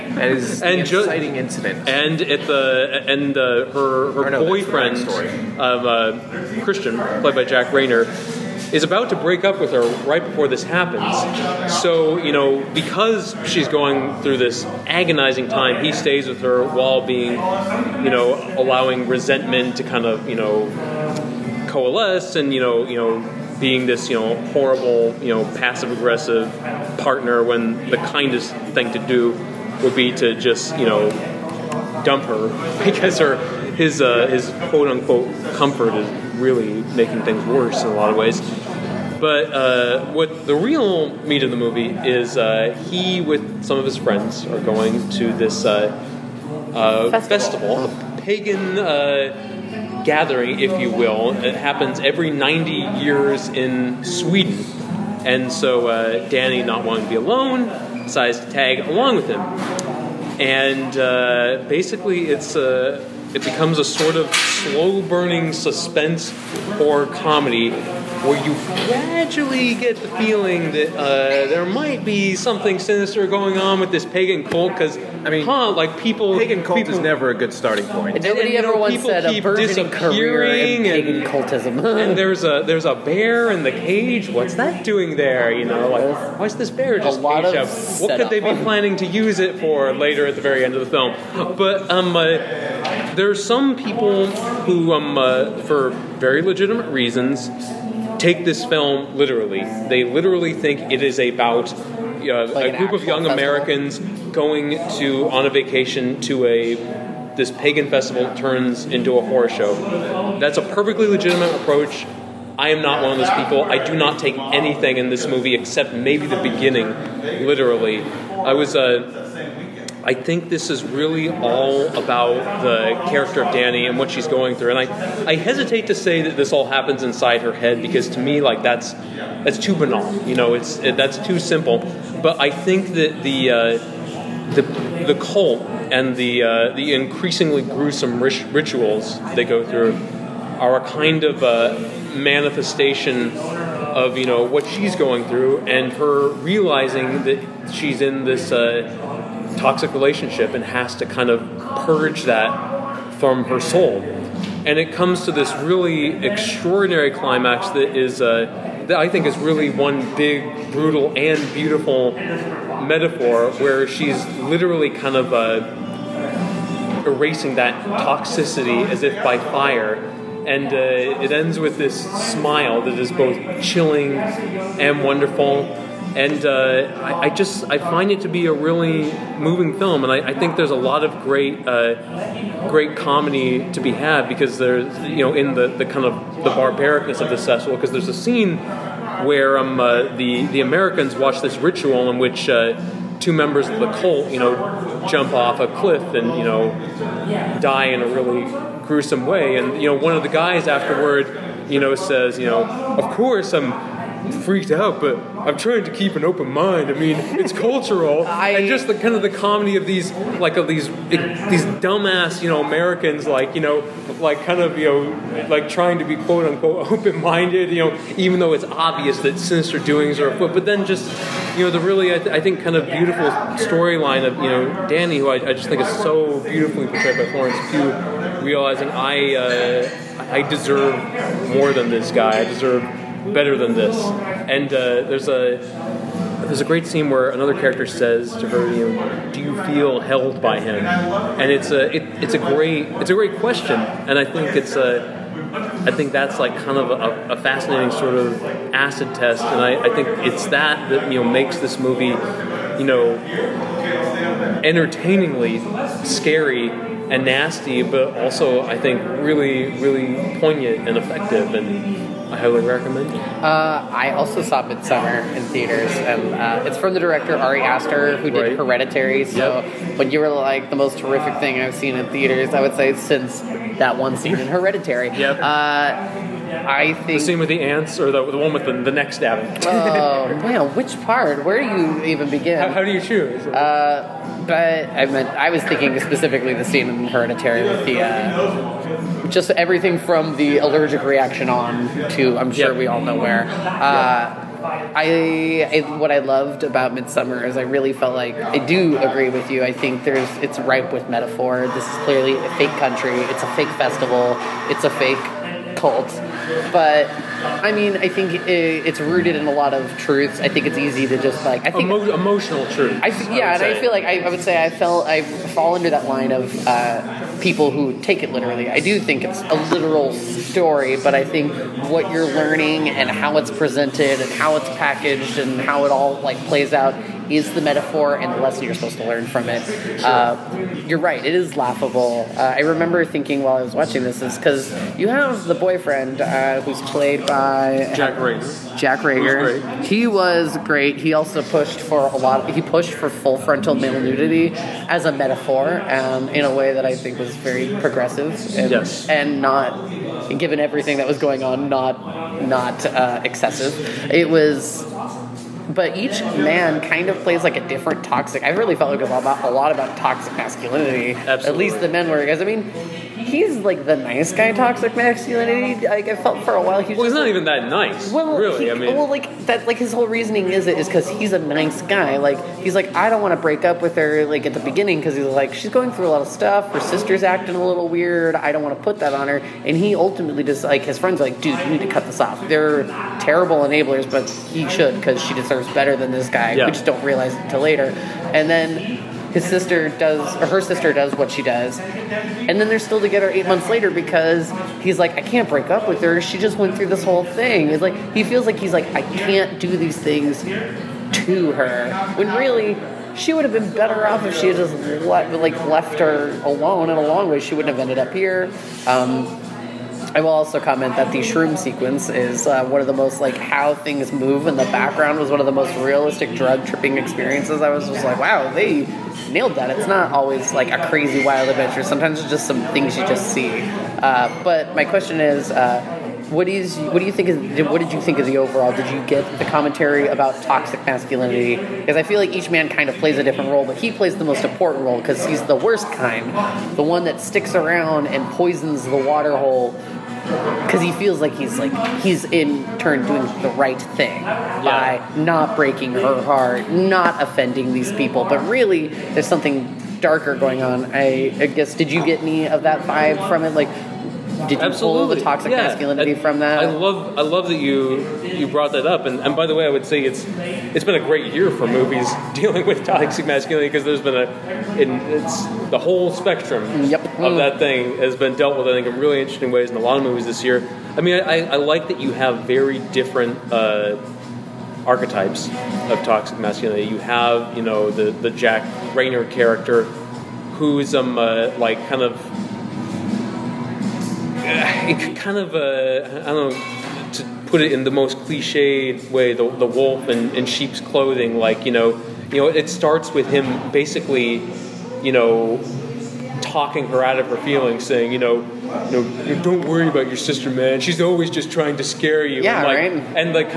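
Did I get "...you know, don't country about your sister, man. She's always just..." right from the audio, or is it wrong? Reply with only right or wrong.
wrong.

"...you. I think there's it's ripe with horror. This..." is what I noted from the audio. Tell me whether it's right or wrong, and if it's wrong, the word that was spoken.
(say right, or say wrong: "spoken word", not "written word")
wrong: "metaphor", not "horror".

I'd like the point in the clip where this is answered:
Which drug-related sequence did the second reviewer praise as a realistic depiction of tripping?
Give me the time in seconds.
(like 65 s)
411 s.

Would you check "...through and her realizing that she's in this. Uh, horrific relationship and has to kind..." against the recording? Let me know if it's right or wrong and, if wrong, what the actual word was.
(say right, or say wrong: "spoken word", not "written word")
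wrong: "toxic", not "horrific".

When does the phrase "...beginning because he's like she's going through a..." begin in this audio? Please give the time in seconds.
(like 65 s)
374 s.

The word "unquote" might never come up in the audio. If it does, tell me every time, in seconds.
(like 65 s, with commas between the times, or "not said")
34 s, 216 s.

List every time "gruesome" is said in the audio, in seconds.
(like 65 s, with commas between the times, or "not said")
137 s, 198 s.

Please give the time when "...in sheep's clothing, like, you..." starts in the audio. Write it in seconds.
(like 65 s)
490 s.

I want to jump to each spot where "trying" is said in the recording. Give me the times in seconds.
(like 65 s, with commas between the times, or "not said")
205 s, 215 s, 501 s.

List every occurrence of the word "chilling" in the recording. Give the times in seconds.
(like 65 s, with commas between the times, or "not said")
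173 s.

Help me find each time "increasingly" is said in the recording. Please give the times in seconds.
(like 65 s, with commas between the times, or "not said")
136 s.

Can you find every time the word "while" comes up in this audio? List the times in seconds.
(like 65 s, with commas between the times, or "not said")
16 s, 333 s, 366 s.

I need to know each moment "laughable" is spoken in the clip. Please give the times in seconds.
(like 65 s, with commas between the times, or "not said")
331 s.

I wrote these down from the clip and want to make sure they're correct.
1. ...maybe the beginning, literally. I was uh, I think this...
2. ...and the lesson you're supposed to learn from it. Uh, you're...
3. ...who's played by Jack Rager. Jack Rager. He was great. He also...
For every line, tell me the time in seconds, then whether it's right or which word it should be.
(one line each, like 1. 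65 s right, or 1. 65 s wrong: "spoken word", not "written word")
1. 115 s right
2. 328 s right
3. 336 s right.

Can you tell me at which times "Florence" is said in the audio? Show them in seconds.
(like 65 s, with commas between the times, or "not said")
227 s.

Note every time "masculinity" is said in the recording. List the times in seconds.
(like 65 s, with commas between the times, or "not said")
360 s, 364 s, 430 s, 455 s, 463 s, 476 s.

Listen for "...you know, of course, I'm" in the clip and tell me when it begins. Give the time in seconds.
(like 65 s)
202 s.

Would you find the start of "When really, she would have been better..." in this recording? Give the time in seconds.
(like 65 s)
402 s.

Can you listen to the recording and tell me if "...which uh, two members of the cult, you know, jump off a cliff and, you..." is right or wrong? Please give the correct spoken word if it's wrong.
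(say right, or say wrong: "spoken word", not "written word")
right.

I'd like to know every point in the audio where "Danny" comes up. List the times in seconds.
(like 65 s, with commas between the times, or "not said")
56 s, 123 s, 224 s.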